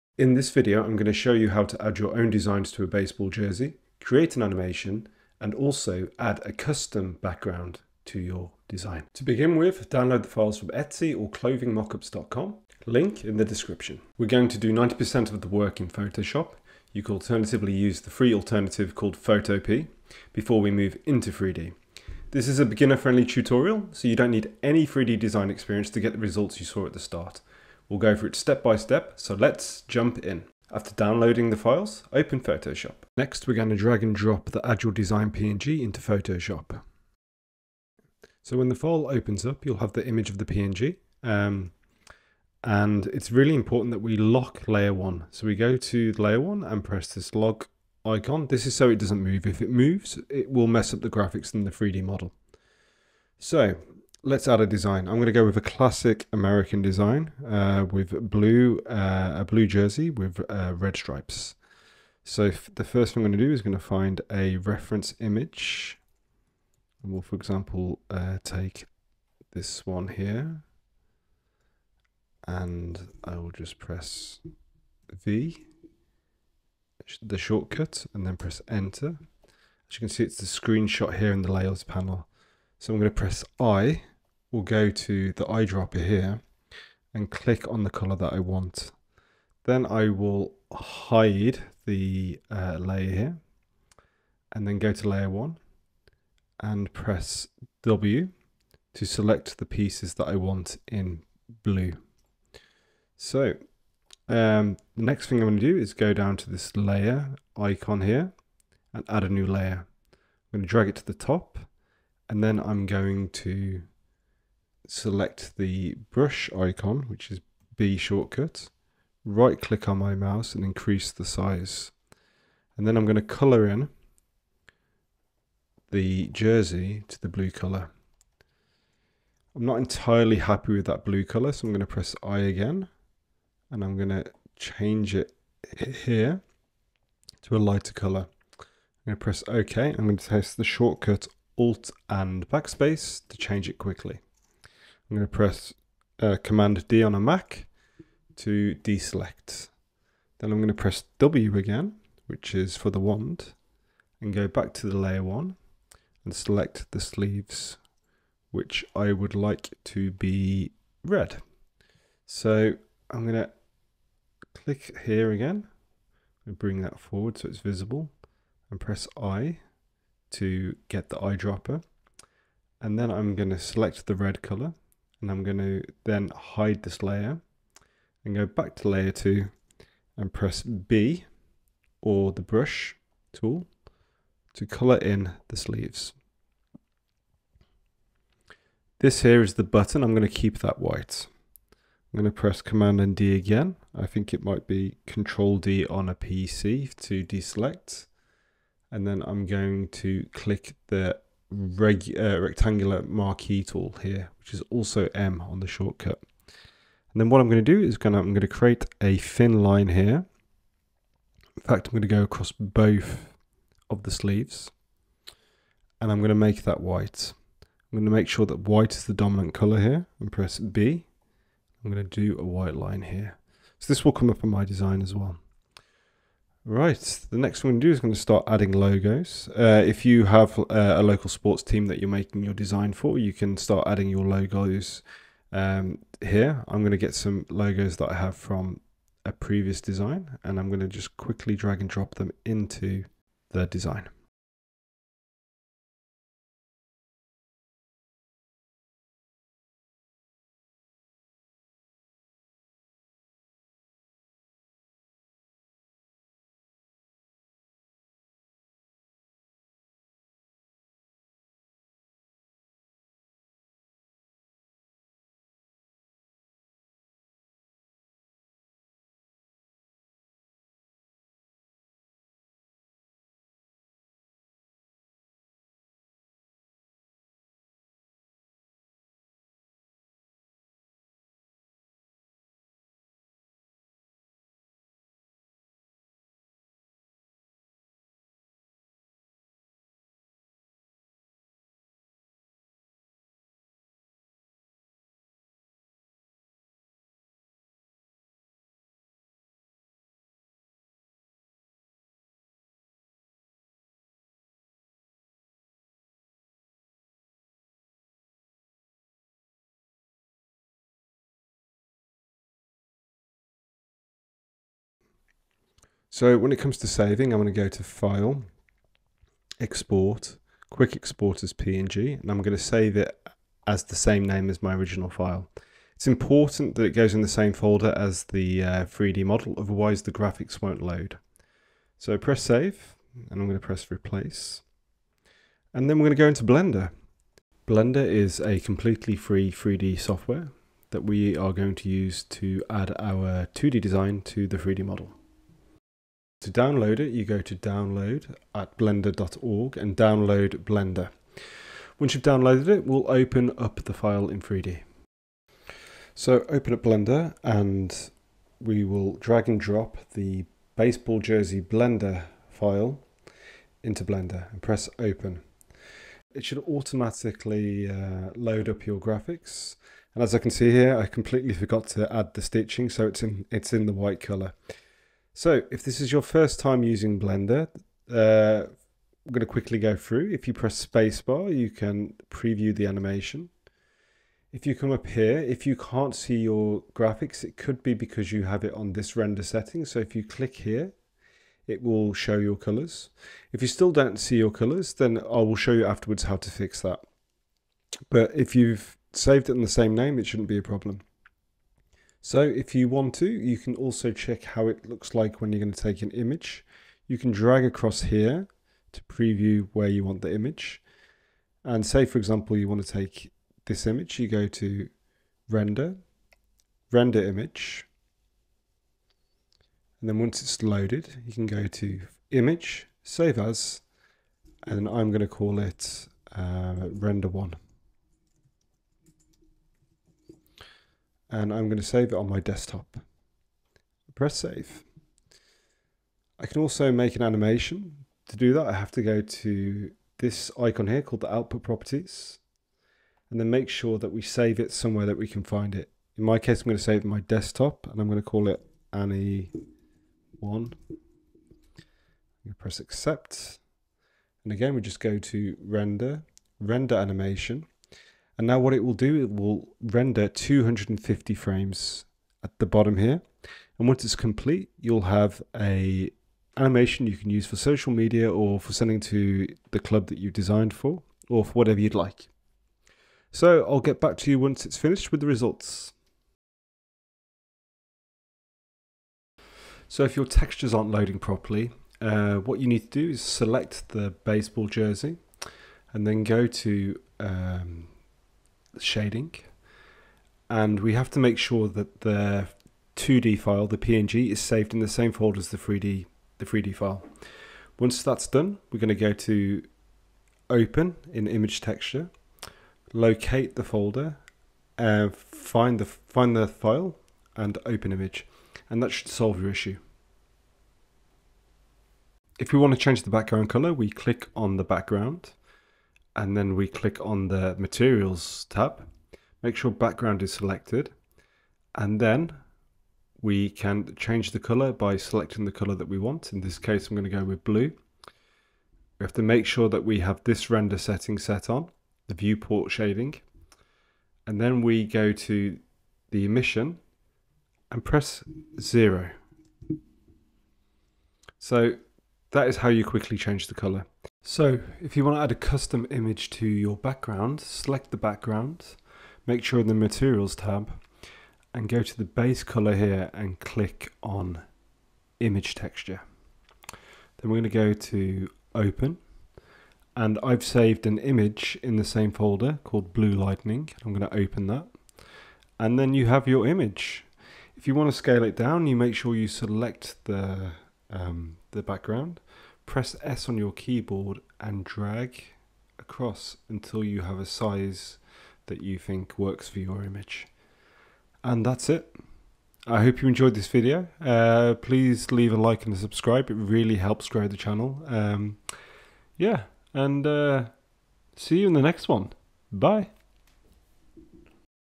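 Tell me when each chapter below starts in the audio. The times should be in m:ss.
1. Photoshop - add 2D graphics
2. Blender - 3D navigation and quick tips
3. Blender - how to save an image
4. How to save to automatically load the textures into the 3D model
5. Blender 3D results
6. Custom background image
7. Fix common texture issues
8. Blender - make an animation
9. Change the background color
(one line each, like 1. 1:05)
1. 0:30
2. 5:53
3. 6:45
4. 5:15
5. 7:54
6. 9:04
7. 8:04
8. 7:18
9. 8:32.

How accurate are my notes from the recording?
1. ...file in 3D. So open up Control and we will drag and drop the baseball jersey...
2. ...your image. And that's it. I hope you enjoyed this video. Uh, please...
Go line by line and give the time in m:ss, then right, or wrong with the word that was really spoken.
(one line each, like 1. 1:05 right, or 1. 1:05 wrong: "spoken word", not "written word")
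1. 5:53 wrong: "Blender", not "Control"
2. 9:39 right.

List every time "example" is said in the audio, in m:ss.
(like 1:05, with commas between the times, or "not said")
1:07, 6:52.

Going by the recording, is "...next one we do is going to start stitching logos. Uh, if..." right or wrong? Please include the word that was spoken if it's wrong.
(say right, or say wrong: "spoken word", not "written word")
wrong: "adding", not "stitching".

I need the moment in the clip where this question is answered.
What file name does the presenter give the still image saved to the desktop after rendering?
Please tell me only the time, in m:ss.
7:06.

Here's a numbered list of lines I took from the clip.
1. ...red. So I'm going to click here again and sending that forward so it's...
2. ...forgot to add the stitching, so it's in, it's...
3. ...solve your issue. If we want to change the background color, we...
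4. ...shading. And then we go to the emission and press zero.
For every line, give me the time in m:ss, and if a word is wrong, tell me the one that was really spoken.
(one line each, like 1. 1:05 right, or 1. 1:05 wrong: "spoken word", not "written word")
1. 2:41 wrong: "bring", not "sending"
2. 6:11 right
3. 8:29 right
4. 8:52 right.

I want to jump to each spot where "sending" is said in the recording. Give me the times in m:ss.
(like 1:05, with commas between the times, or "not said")
7:48.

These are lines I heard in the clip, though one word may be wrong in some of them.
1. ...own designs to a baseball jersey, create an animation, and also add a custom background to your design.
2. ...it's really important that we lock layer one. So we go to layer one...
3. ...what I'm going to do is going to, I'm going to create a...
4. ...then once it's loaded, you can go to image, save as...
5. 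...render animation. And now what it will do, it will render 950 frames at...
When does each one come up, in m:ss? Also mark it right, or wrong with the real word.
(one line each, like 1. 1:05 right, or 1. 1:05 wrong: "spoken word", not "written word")
1. 0:02 right
2. 0:43 right
3. 3:27 right
4. 7:00 right
5. 7:36 wrong: "250", not "950".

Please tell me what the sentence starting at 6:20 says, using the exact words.
If you press spacebar, you can preview the animation.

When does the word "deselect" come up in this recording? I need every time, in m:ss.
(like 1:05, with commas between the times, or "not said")
2:28, 3:17.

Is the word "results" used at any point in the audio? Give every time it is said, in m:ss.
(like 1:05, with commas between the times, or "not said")
0:26, 7:55.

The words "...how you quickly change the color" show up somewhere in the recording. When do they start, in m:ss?
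9:02.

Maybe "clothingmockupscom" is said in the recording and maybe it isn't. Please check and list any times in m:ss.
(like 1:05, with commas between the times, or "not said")
0:11.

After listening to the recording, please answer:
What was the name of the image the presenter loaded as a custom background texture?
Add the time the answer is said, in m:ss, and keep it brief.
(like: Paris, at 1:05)
blue lightning, at 9:22.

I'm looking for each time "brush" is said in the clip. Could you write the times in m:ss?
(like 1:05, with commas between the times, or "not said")
1:56, 3:02.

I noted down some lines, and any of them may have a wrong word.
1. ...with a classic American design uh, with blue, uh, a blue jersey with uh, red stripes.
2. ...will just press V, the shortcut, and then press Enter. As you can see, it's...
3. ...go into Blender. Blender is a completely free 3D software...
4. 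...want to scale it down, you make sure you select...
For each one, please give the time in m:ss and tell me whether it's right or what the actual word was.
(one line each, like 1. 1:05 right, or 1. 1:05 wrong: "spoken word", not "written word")
1. 0:55 right
2. 1:13 right
3. 5:36 right
4. 9:27 right.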